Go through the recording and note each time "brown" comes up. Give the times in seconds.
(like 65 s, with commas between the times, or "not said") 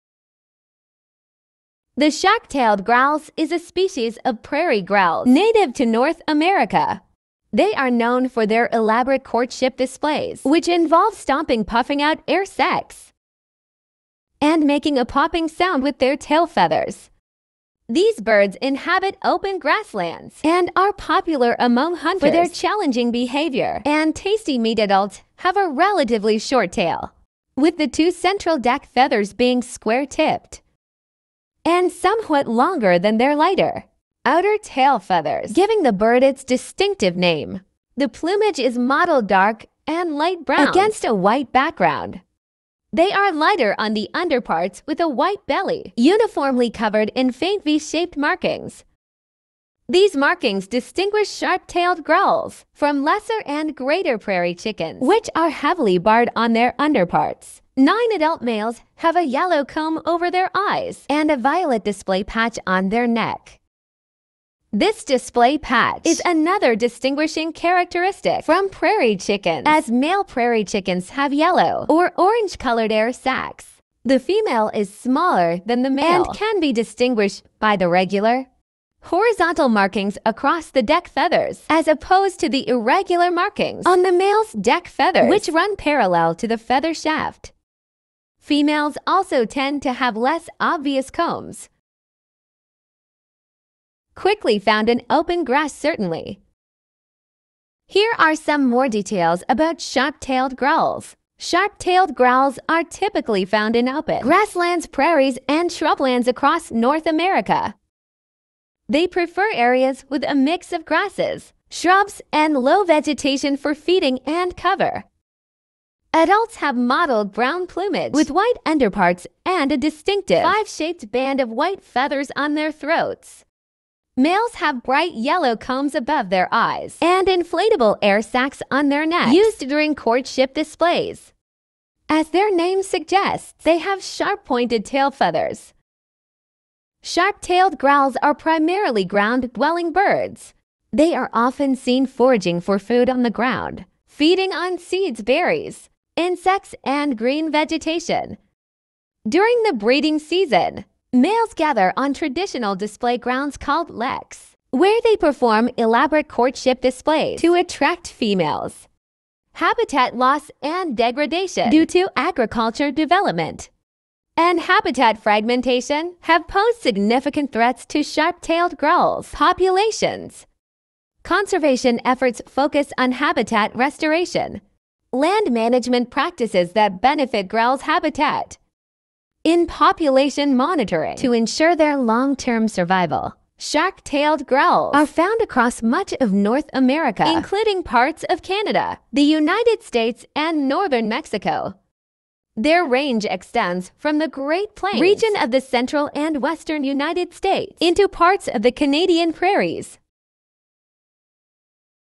40 s, 117 s.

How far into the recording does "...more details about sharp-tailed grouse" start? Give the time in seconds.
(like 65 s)
98 s.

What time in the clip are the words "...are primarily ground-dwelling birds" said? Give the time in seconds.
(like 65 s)
138 s.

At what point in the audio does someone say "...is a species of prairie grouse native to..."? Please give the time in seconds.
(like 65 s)
3 s.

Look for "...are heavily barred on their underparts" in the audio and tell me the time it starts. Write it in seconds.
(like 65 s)
55 s.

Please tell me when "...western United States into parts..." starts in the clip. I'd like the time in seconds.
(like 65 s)
196 s.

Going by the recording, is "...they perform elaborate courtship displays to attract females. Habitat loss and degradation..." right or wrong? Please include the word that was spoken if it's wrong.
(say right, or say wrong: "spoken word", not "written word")
right.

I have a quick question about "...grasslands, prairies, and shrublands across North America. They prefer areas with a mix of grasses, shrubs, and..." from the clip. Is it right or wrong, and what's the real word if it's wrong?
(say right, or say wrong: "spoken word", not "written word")
right.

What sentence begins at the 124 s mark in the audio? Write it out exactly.
Males have bright yellow combs above their eyes and inflatable air sacs on their necks used during courtship displays.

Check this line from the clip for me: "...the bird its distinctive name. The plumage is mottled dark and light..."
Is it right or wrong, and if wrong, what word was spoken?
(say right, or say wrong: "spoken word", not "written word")
right.